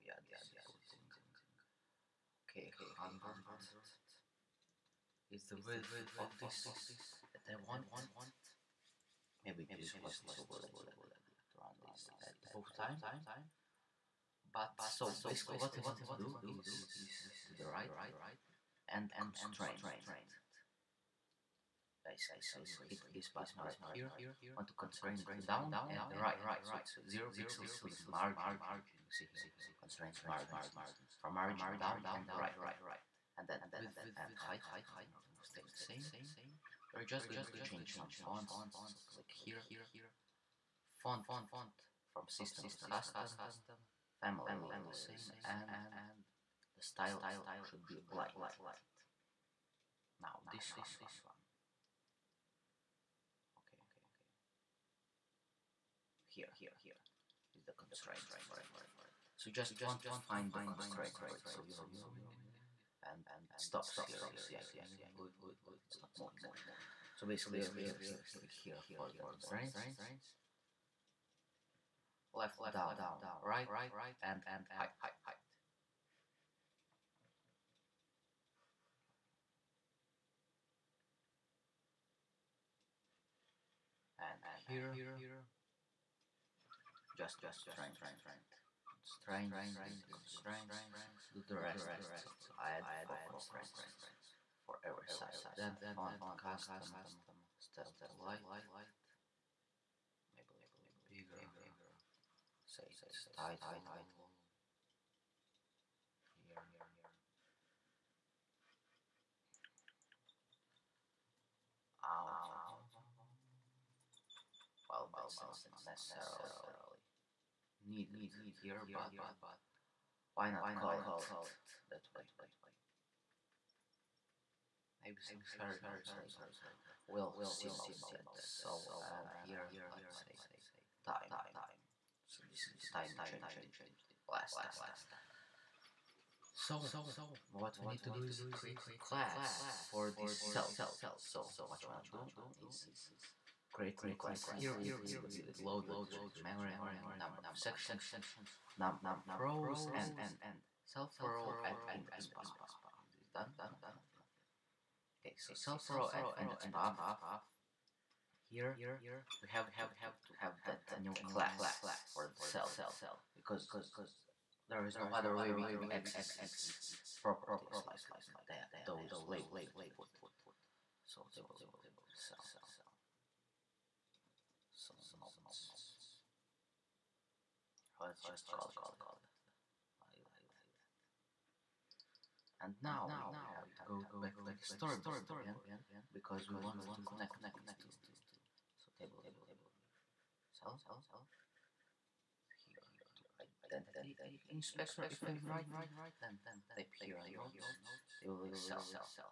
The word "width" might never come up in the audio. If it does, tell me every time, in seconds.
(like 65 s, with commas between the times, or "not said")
5 s, 33 s.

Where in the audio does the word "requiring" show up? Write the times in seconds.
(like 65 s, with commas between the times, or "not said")
not said.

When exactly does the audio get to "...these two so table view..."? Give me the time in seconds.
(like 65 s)
187 s.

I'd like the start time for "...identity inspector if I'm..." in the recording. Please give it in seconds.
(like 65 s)
193 s.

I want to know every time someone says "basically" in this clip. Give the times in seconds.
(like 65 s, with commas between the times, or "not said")
15 s, 22 s, 67 s.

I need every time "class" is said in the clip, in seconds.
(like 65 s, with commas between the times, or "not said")
139 s, 144 s, 161 s.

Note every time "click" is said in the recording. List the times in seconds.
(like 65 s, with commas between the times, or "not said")
39 s, 68 s.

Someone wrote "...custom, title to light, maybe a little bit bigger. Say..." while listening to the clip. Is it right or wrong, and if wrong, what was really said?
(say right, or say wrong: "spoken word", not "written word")
wrong: "style", not "title".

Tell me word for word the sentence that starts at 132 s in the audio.
So this is the time you changed it last time.